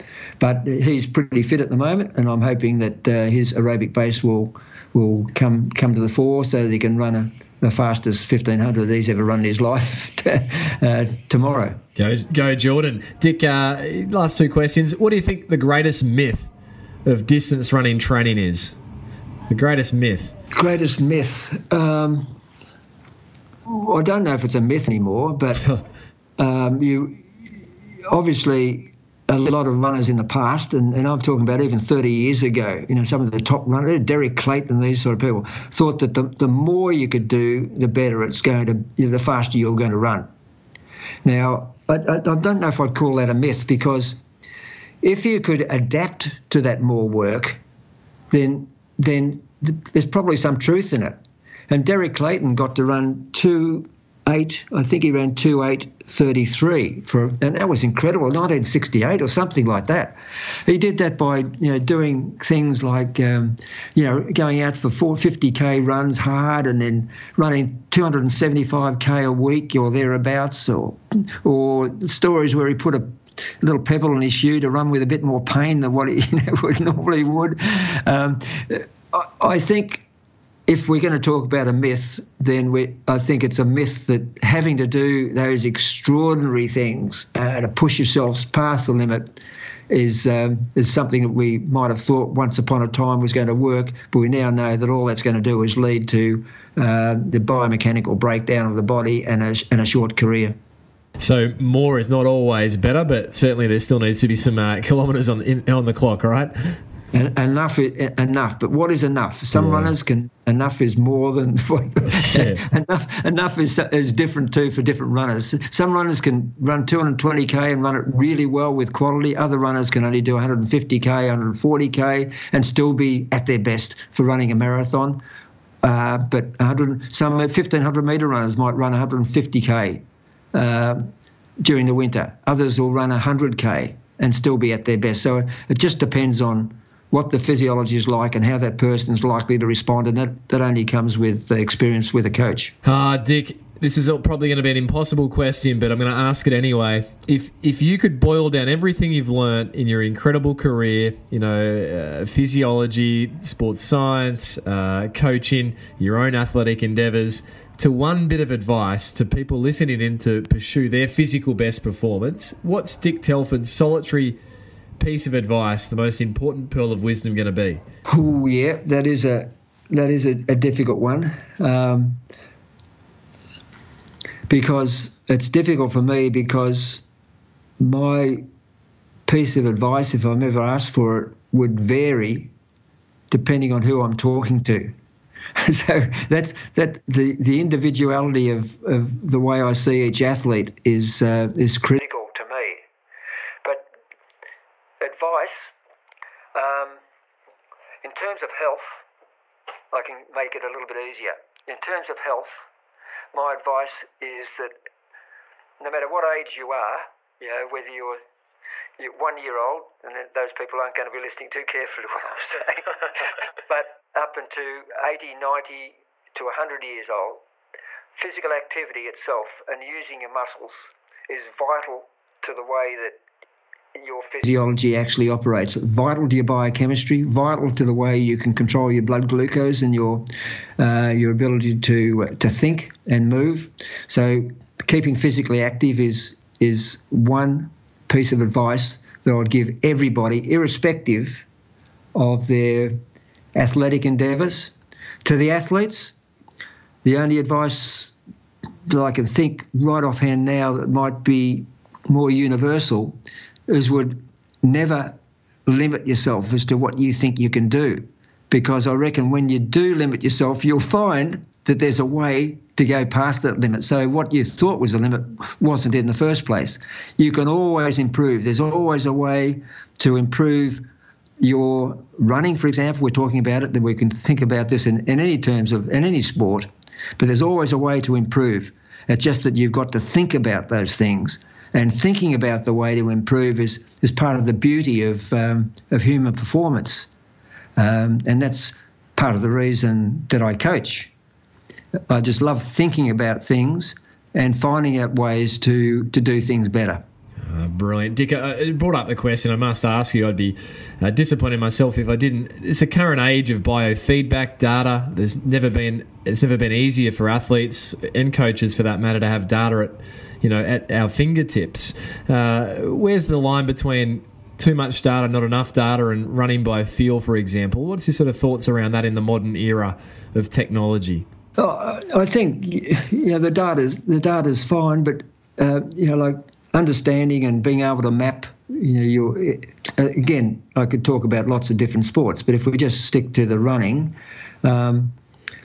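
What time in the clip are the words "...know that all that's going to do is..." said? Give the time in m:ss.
1:34.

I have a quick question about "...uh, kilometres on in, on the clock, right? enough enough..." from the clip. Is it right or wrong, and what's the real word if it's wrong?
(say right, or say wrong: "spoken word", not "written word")
right.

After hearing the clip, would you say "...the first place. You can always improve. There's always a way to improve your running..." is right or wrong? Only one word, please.
right.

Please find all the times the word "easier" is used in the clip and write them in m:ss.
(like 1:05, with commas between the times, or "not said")
3:20, 5:06.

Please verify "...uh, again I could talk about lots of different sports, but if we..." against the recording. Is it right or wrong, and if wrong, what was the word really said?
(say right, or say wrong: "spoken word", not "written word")
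right.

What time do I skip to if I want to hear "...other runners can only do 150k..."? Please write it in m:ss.
1:59.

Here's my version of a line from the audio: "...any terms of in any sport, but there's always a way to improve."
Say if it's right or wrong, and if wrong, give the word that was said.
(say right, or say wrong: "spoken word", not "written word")
right.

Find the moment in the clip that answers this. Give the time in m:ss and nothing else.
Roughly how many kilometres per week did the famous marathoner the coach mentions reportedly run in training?
1:07.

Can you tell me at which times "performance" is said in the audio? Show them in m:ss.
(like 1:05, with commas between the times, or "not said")
2:41, 4:46.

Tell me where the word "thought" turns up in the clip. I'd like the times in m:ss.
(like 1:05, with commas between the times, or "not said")
0:35, 1:31, 4:24, 5:18.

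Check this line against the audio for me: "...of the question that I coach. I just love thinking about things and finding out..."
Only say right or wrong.
wrong.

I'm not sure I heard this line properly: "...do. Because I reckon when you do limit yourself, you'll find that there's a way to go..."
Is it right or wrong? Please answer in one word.
right.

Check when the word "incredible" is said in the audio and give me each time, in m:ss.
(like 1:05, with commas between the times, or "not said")
0:57, 2:30.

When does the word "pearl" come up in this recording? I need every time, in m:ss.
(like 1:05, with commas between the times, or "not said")
2:46.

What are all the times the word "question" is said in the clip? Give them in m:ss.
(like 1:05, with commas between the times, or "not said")
0:14, 2:25, 4:59.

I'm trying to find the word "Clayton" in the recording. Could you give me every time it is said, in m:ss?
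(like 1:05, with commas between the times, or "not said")
0:34, 0:52.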